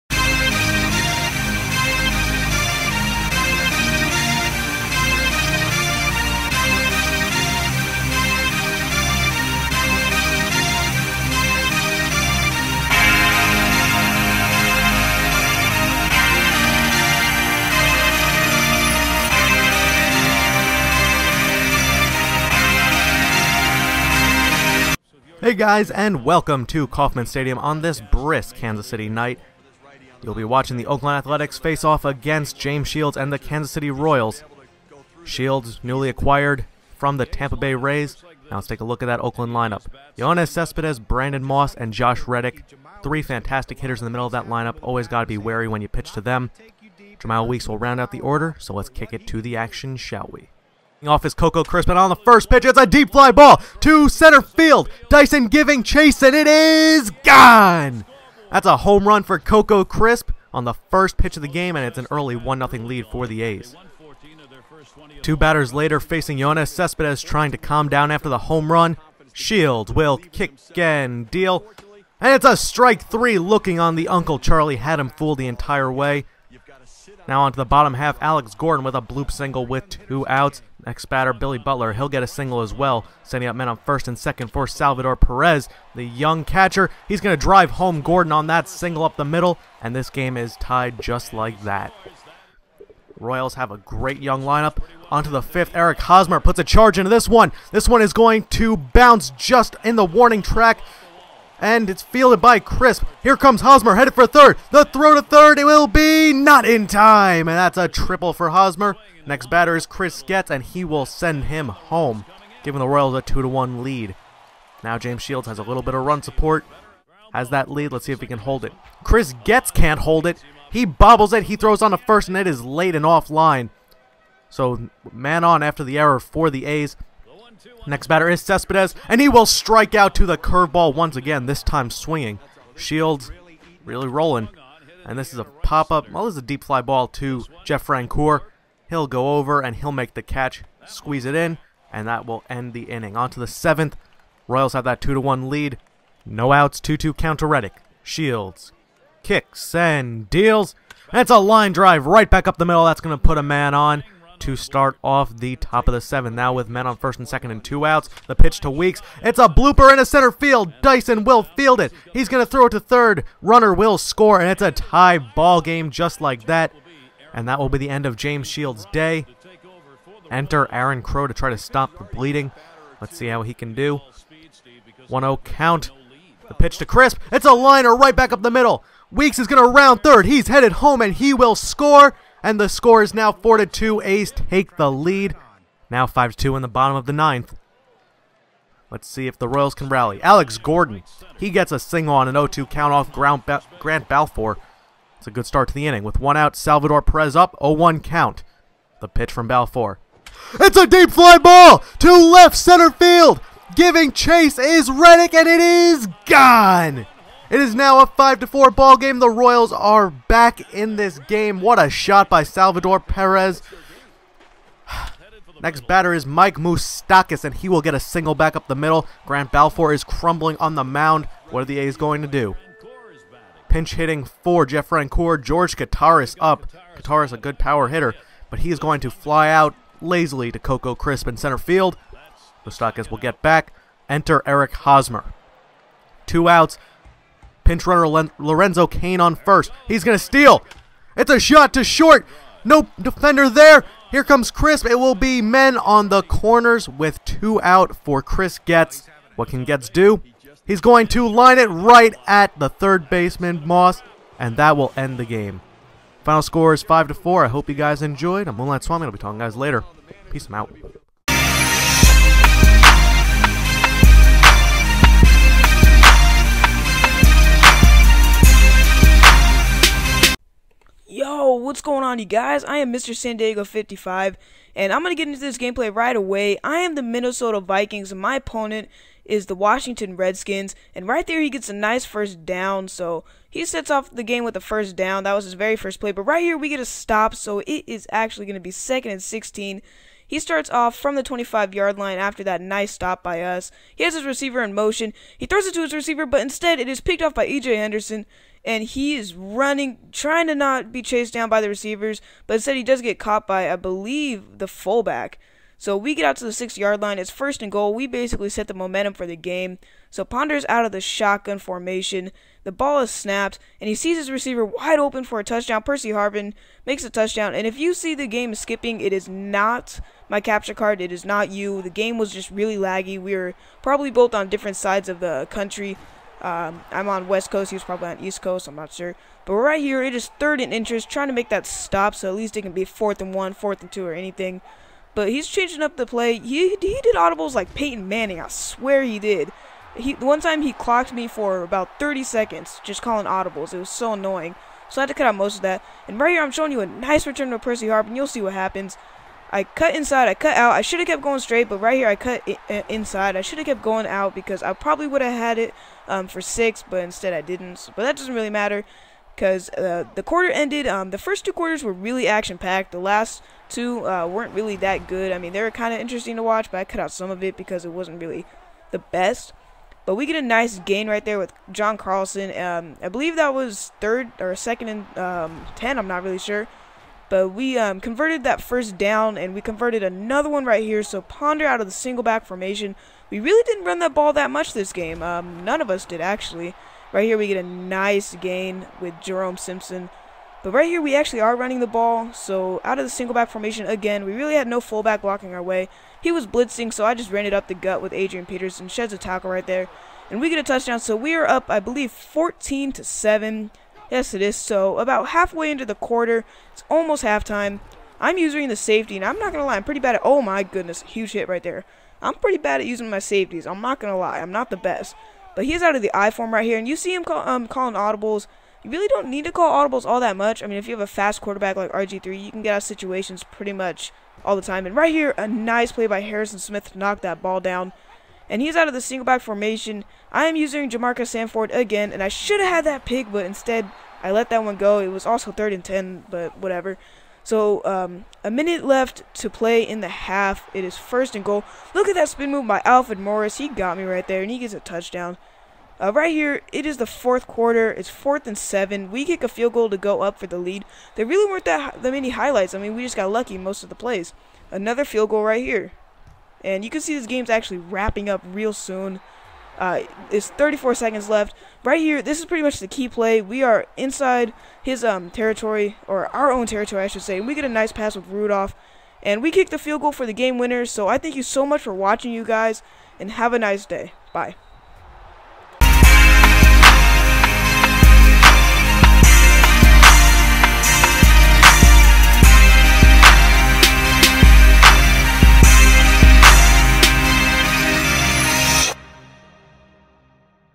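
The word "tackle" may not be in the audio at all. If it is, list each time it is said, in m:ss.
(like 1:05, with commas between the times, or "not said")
6:39.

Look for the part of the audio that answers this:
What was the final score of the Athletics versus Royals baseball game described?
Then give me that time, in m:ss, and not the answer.
4:16.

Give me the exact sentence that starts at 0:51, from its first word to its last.
off his Coco Crisp, and on the first pitch, it's a deep fly ball to center field.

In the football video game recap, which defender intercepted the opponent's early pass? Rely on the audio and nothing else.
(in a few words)
EJ Henderson.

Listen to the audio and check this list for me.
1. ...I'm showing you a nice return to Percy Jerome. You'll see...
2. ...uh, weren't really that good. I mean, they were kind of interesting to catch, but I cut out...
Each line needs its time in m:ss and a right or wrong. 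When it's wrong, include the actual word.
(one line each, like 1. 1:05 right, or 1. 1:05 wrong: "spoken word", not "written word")
1. 5:46 wrong: "Harvin", not "Jerome"
2. 6:04 wrong: "watch", not "catch".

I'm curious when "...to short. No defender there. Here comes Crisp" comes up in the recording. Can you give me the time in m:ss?
4:01.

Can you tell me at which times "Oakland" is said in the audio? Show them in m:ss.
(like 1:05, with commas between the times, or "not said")
0:30, 0:39.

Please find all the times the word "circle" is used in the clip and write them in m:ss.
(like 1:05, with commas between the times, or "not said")
not said.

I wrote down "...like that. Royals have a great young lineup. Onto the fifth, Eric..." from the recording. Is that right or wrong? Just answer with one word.
right.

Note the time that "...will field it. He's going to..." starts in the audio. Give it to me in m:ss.
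2:41.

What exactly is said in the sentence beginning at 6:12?
Um, I believe that was third or second and um, ten.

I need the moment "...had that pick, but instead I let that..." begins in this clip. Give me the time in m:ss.
7:12.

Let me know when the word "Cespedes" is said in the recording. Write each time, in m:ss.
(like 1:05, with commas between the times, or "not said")
0:40, 1:06, 2:08.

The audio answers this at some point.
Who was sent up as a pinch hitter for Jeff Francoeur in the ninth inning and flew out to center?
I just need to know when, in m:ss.
3:45.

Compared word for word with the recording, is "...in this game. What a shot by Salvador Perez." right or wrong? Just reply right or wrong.
right.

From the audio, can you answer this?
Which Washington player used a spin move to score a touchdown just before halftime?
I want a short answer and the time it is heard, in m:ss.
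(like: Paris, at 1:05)
Alfred Morris, at 7:22.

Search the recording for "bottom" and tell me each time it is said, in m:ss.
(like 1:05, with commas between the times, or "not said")
1:17, 3:06.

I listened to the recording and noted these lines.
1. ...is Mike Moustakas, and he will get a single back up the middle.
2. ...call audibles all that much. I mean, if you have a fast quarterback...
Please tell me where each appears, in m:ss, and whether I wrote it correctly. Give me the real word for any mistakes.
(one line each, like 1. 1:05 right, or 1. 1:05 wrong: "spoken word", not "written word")
1. 3:36 right
2. 6:59 right.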